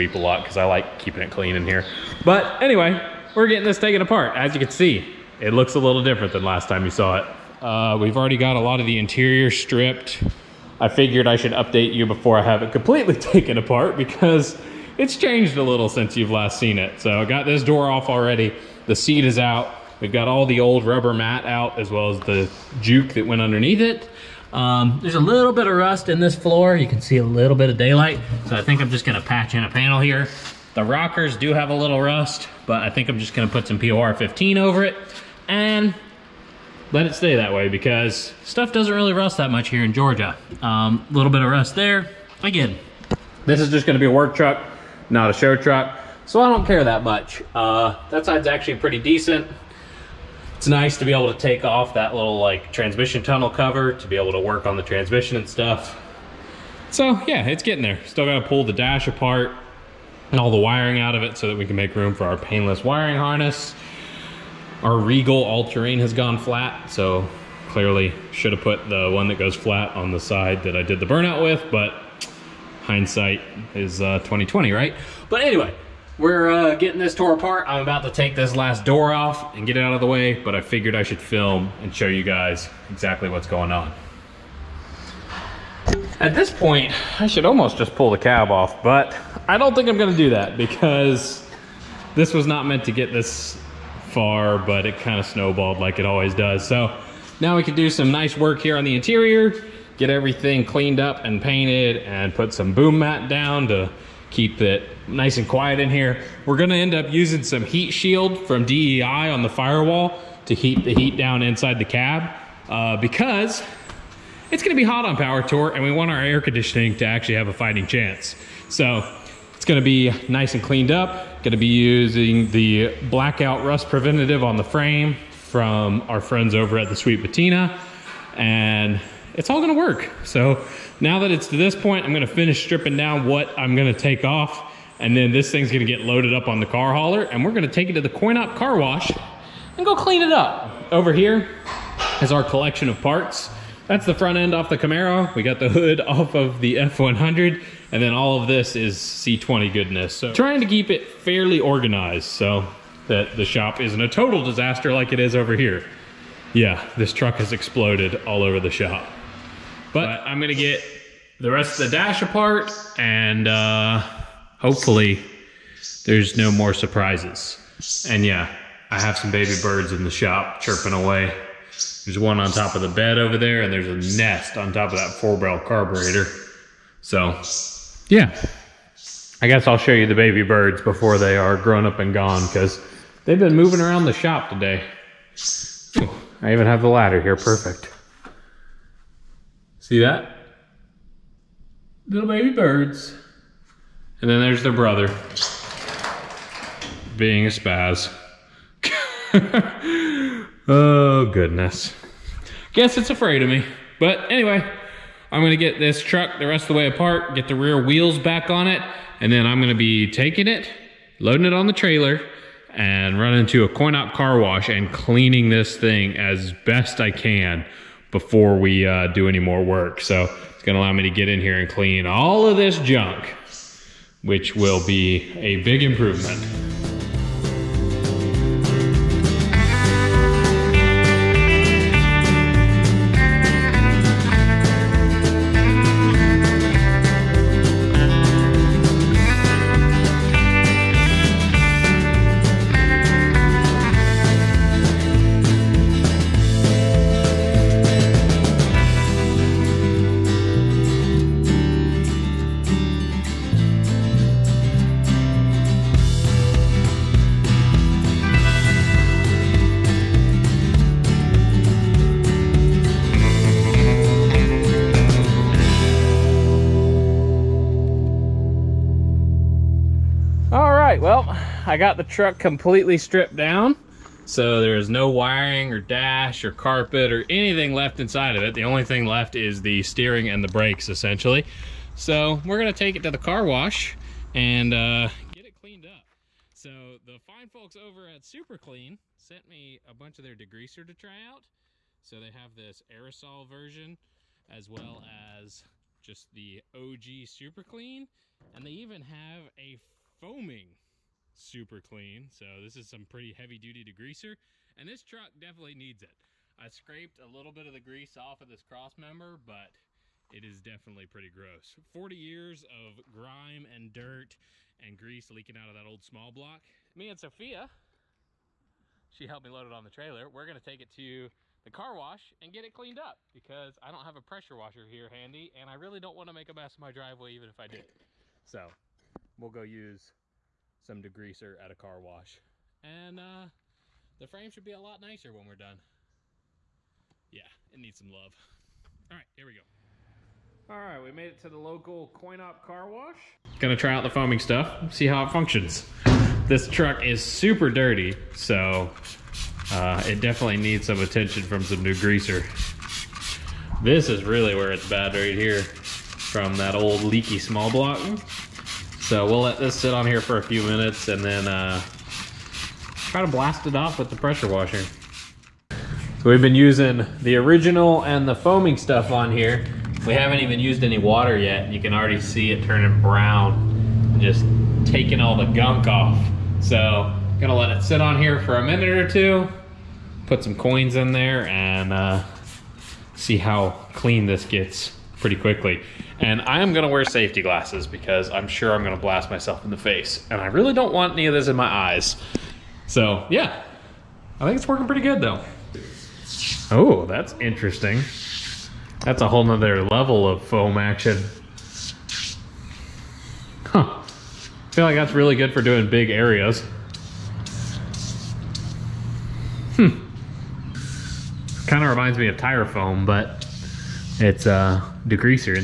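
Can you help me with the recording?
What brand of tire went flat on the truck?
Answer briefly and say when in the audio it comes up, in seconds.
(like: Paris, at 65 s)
Regal all-terrain, at 64 s.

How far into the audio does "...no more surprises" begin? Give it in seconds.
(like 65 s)
166 s.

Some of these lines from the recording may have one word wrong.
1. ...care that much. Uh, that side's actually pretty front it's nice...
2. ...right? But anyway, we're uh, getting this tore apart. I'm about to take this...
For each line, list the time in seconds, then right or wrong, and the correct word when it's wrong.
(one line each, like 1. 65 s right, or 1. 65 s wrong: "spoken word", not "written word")
1. 46 s wrong: "decent", not "front"
2. 74 s right.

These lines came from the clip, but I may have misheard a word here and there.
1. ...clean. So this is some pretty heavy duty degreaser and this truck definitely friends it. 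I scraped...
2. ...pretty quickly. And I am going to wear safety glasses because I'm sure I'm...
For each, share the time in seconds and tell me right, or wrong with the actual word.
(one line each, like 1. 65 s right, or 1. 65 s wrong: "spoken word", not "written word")
1. 301 s wrong: "needs", not "friends"
2. 385 s right.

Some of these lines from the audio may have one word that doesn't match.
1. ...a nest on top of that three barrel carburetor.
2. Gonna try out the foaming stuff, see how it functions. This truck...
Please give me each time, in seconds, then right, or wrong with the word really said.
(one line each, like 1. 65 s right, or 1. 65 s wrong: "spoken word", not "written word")
1. 174 s wrong: "four", not "three"
2. 343 s right.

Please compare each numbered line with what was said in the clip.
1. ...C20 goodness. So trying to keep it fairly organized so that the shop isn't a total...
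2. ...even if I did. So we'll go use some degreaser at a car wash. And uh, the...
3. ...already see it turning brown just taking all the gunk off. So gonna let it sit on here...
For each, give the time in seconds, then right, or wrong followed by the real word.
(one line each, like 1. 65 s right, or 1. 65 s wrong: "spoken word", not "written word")
1. 148 s right
2. 327 s right
3. 371 s right.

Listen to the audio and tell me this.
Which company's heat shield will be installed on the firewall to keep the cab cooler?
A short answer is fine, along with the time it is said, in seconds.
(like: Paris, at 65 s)
DEI, at 108 s.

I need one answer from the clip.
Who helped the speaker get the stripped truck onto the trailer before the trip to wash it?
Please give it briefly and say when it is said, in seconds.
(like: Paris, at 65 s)
Sophia, at 317 s.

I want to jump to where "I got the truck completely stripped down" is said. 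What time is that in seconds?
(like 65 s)
271 s.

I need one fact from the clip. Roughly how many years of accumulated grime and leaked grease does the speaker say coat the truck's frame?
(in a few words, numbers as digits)
40.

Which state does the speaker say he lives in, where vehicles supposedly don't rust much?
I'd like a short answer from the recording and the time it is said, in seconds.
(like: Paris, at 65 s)
Georgia, at 39 s.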